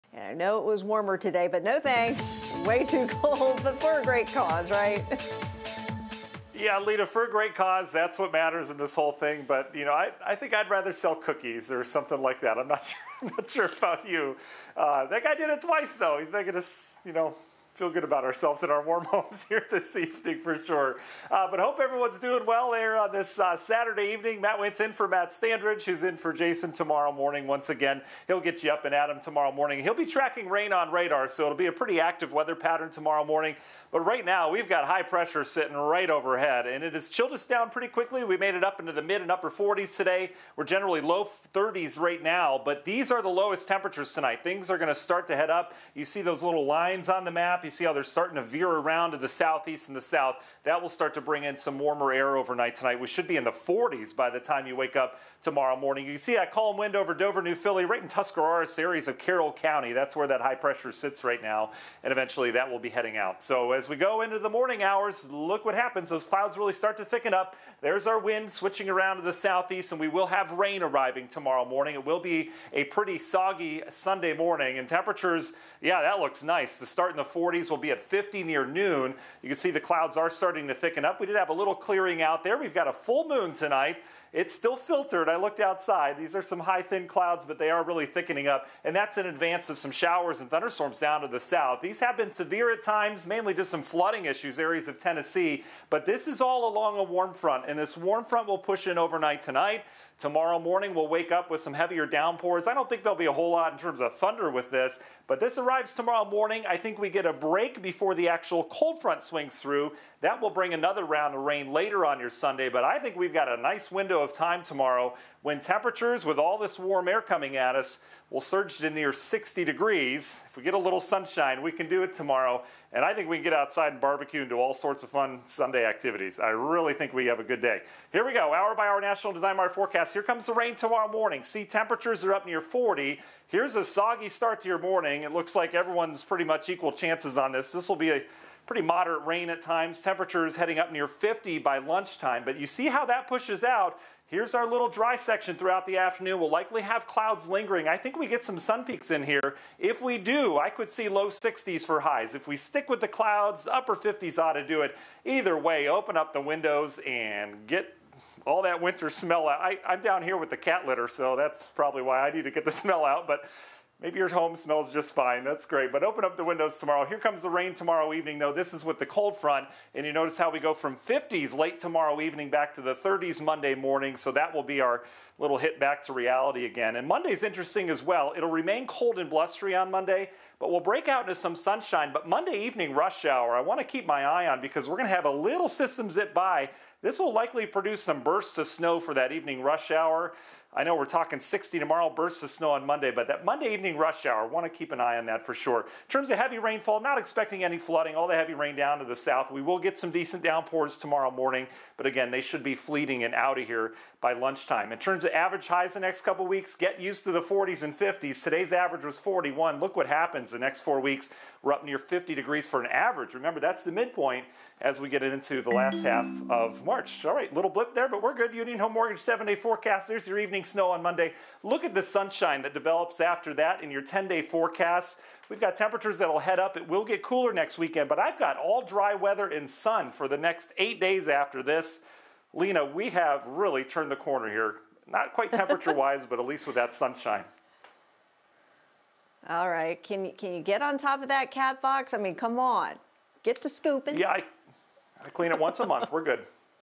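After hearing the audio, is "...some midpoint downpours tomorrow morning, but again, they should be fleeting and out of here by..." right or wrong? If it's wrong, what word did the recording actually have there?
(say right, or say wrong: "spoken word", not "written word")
wrong: "decent", not "midpoint".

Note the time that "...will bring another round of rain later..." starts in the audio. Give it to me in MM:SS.
01:50.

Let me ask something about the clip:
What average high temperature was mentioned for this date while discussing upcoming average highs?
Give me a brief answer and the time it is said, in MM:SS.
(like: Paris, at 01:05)
41, at 03:29.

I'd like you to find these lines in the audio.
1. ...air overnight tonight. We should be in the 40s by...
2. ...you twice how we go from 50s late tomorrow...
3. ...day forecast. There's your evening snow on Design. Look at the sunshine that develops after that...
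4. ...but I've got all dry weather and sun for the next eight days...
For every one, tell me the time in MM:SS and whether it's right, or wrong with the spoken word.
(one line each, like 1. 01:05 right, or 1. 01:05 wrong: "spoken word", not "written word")
1. 00:52 right
2. 02:50 wrong: "notice", not "twice"
3. 03:39 wrong: "Monday", not "Design"
4. 03:48 right.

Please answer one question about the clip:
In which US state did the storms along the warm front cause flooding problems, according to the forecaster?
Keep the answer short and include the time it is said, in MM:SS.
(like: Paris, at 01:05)
Tennessee, at 01:34.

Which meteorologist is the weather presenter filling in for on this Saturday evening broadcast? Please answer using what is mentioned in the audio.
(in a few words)
Matt Standridge.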